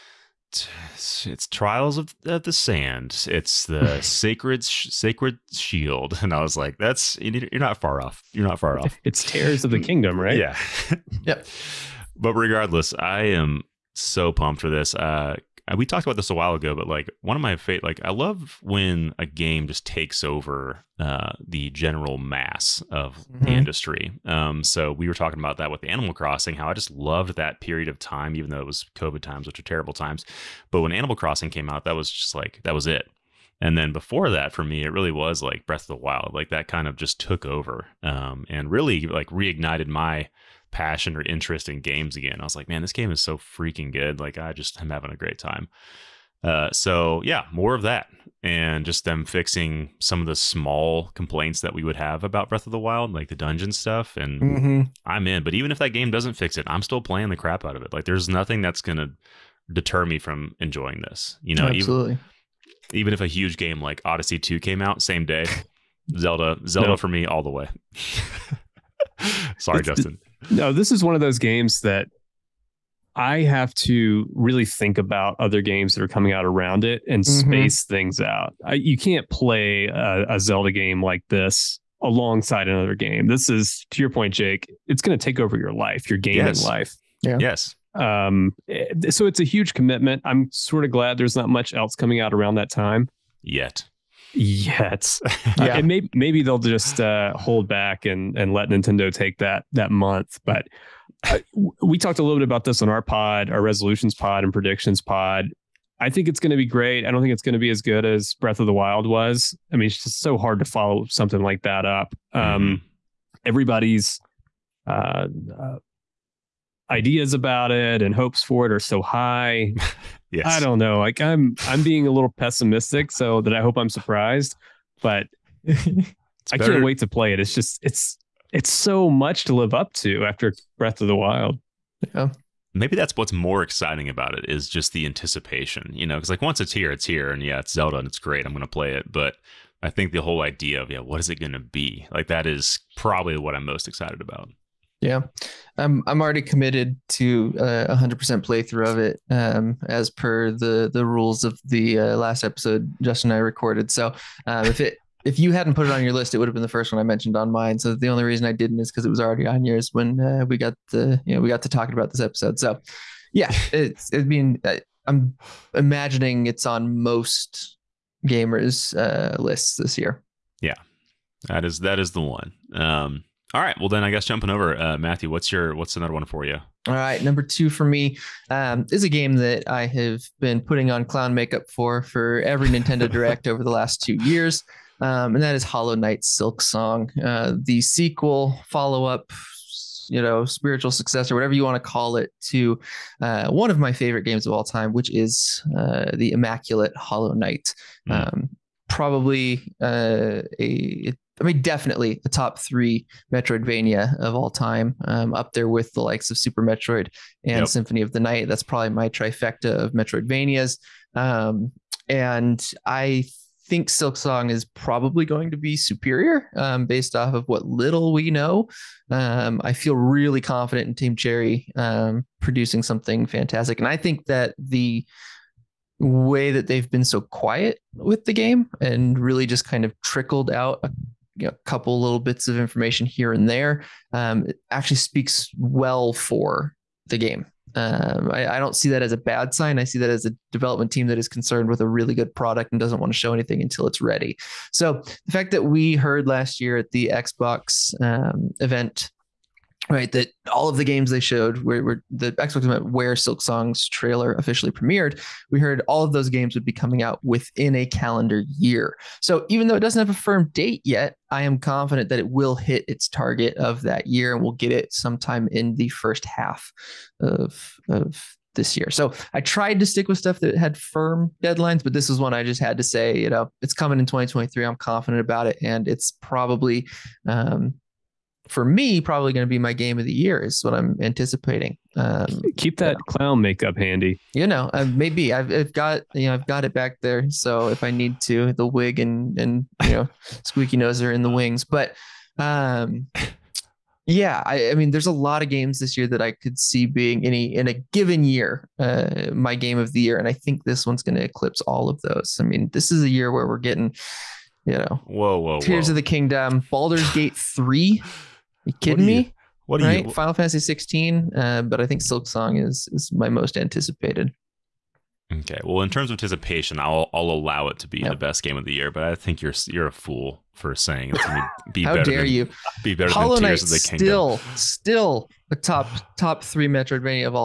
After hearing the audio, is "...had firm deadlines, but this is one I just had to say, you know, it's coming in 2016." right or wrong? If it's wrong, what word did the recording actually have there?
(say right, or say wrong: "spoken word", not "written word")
wrong: "2023", not "2016".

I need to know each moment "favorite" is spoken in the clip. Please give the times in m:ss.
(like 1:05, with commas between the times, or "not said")
0:17, 3:13.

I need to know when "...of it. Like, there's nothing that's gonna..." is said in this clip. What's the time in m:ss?
0:57.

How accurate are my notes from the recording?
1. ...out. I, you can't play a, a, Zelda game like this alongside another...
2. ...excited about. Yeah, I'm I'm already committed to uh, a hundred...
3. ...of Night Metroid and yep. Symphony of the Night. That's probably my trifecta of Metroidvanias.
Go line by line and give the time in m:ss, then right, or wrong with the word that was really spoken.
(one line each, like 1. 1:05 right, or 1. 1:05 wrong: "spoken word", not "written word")
1. 1:18 right
2. 2:23 right
3. 3:26 wrong: "Super", not "Night".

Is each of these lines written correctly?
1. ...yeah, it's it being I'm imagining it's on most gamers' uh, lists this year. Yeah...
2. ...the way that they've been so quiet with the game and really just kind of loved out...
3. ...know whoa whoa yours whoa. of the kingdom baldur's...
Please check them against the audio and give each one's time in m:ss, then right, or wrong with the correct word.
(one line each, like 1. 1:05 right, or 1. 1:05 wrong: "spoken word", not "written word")
1. 2:43 right
2. 3:44 wrong: "trickled", not "loved"
3. 5:04 wrong: "tears", not "yours".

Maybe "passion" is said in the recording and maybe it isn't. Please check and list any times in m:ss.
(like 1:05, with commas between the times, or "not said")
0:40.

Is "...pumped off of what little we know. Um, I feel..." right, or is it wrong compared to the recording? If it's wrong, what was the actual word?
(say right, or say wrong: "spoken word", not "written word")
wrong: "based", not "pumped".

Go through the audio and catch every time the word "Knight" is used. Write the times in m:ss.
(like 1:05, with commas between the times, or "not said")
3:05, 3:17, 5:23.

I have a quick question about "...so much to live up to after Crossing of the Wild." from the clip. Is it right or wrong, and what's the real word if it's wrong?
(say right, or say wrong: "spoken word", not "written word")
wrong: "Breath", not "Crossing".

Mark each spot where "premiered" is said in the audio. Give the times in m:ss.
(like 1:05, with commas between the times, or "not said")
4:14.